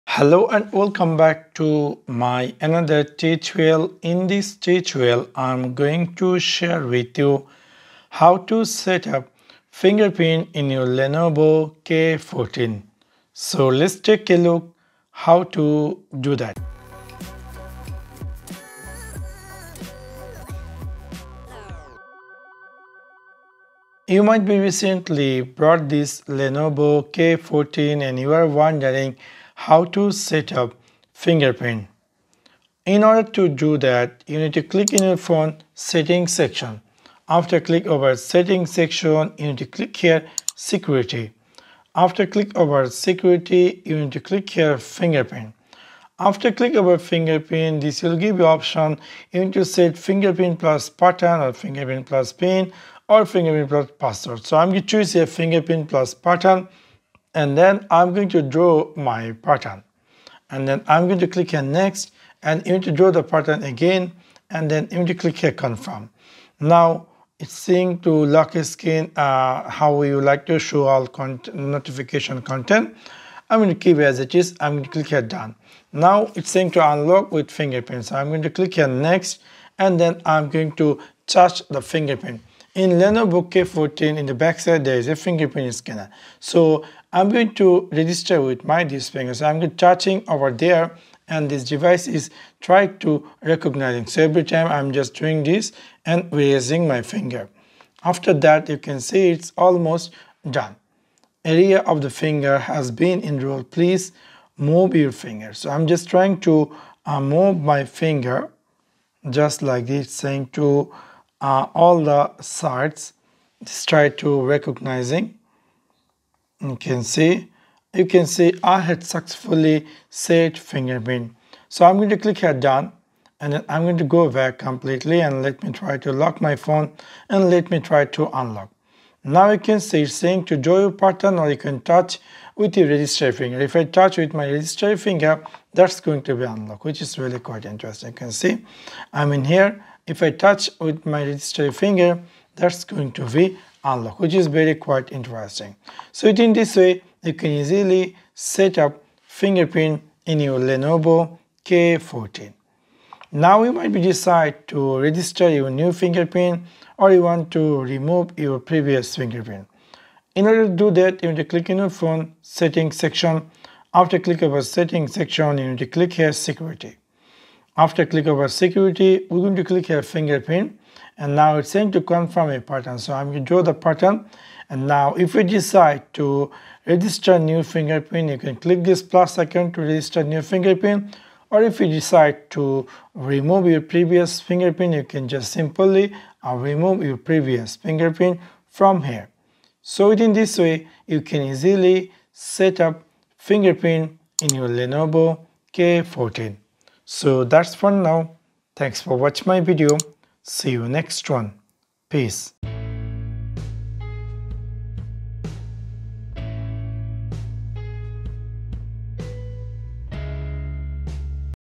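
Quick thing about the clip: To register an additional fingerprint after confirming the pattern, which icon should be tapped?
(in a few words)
Plus icon.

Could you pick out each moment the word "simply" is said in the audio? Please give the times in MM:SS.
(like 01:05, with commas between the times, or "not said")
03:05.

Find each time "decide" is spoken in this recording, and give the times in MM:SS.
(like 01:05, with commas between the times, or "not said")
02:34, 02:55, 03:01.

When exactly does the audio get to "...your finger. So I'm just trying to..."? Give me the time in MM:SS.
01:44.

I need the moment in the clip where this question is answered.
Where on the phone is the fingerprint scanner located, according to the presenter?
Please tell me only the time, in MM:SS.
01:24.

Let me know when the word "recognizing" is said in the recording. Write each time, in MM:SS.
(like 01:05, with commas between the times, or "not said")
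01:33, 01:54.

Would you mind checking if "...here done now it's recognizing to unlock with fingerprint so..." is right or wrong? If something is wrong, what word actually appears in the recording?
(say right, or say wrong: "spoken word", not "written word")
wrong: "saying", not "recognizing".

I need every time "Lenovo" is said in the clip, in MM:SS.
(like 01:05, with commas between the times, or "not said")
00:10, 00:26, 01:22, 02:30, 03:14.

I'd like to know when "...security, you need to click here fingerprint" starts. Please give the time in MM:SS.
00:42.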